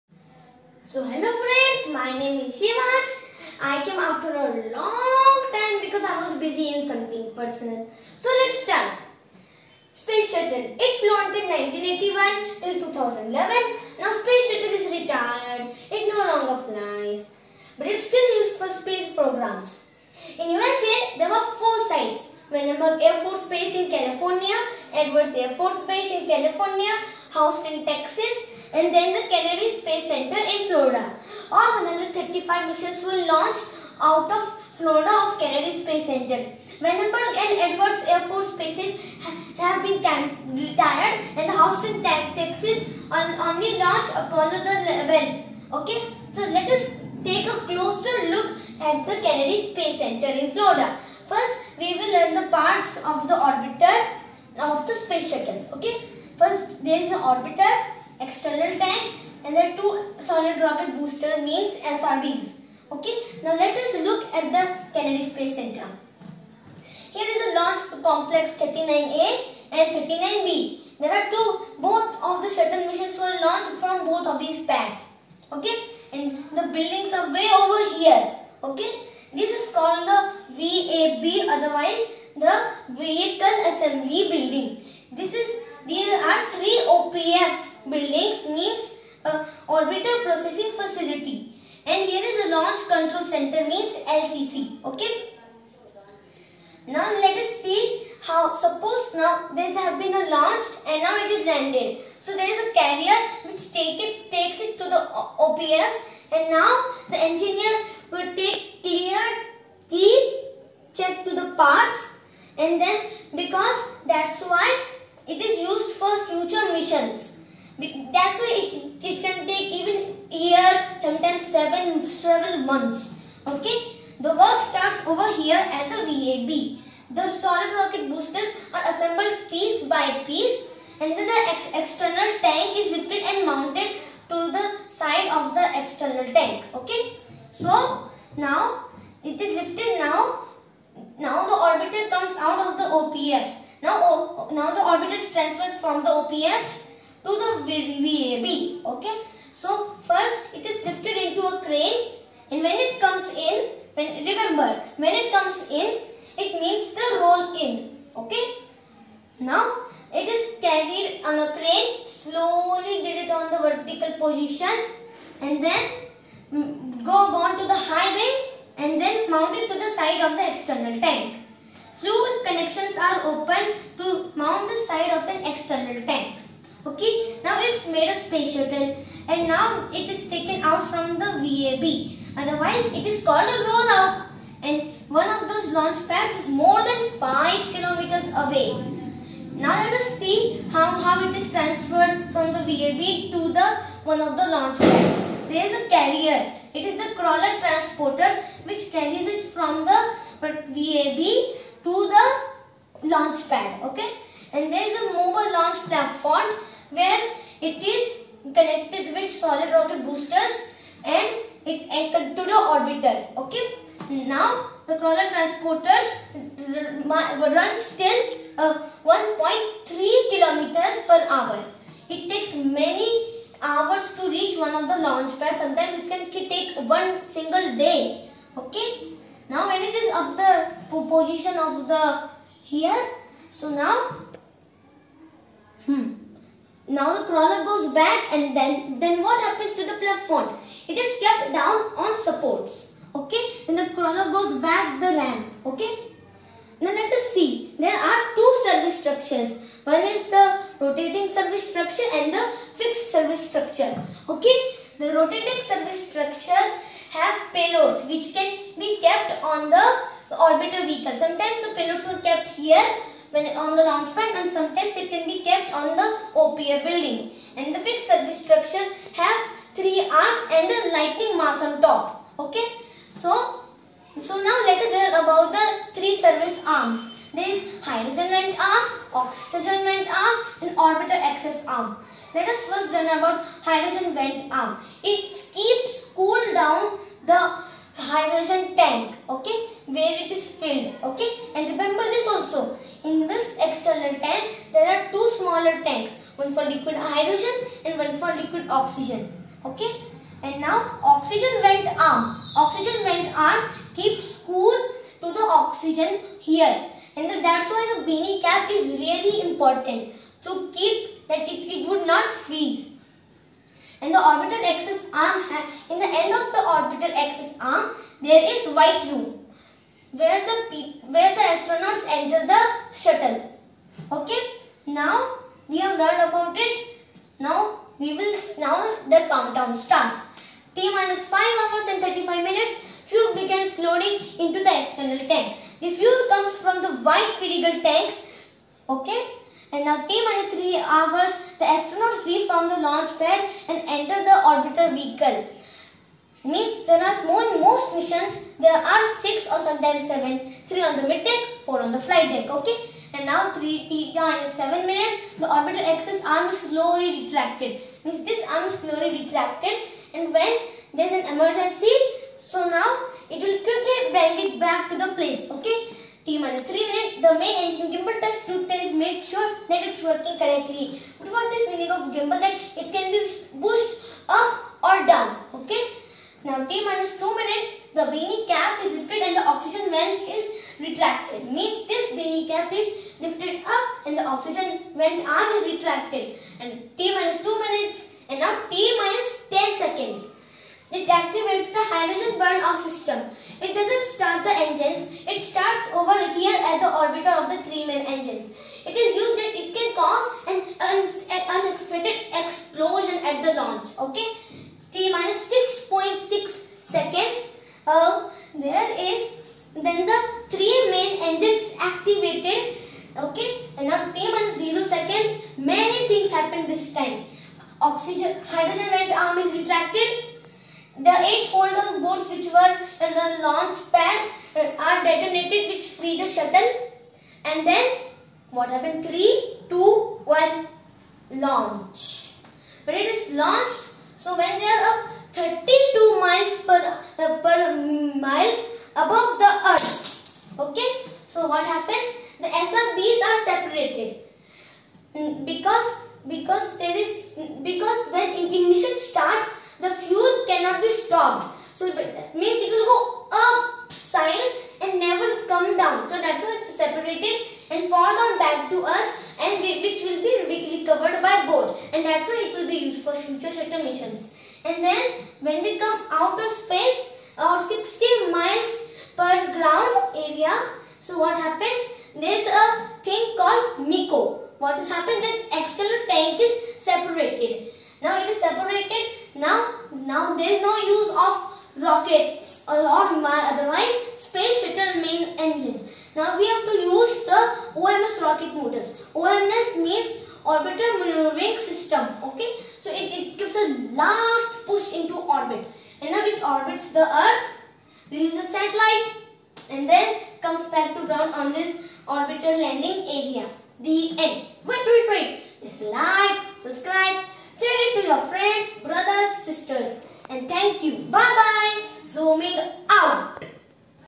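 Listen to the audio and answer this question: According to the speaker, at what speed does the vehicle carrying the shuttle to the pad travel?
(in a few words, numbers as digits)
1.3 km/h.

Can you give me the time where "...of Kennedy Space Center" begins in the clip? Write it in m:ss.
0:35.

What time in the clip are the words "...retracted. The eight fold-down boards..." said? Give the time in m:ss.
6:59.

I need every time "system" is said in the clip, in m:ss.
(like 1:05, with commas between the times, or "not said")
6:32, 8:11.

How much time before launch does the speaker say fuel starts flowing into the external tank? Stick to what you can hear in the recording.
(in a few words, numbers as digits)
T minus 5 hours 35 minutes.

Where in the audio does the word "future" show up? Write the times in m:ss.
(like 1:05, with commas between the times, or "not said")
1:56, 7:43.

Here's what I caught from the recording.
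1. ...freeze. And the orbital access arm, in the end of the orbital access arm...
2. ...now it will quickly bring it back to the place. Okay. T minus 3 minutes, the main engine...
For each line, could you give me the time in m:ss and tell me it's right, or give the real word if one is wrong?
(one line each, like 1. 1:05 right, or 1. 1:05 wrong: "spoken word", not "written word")
1. 5:12 right
2. 6:02 right.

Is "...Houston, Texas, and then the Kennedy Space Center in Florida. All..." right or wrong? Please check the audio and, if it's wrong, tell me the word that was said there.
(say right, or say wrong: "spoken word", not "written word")
right.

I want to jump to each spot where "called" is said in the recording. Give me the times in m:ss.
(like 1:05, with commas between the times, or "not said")
1:19, 3:03.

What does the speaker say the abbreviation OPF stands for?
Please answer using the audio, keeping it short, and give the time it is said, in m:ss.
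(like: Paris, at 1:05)
Orbital Processing Facility, at 1:29.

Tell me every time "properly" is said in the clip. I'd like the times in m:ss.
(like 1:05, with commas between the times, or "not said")
not said.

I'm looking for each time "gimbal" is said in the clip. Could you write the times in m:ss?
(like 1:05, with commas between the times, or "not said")
6:07, 6:12.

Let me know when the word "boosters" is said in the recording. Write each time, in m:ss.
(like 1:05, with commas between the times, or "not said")
1:00, 2:08, 3:30.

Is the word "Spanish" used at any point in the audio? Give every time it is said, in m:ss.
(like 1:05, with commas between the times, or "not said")
not said.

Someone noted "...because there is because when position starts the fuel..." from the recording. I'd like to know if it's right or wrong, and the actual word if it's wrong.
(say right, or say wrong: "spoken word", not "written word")
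wrong: "ignition", not "position".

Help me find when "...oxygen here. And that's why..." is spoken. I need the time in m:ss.
5:05.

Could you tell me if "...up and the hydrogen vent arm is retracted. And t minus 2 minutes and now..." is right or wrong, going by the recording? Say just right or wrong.
wrong.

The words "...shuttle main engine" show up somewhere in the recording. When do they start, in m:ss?
8:04.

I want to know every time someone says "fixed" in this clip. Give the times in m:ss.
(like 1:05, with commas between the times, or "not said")
4:12, 4:27.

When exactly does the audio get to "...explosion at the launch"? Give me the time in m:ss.
6:42.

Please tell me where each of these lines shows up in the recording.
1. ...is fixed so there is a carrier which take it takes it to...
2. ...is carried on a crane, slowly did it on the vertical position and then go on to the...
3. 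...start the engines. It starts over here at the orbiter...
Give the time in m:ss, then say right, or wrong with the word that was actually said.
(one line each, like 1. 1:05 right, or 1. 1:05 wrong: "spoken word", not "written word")
1. 1:41 wrong: "landed", not "fixed"
2. 2:40 right
3. 6:34 right.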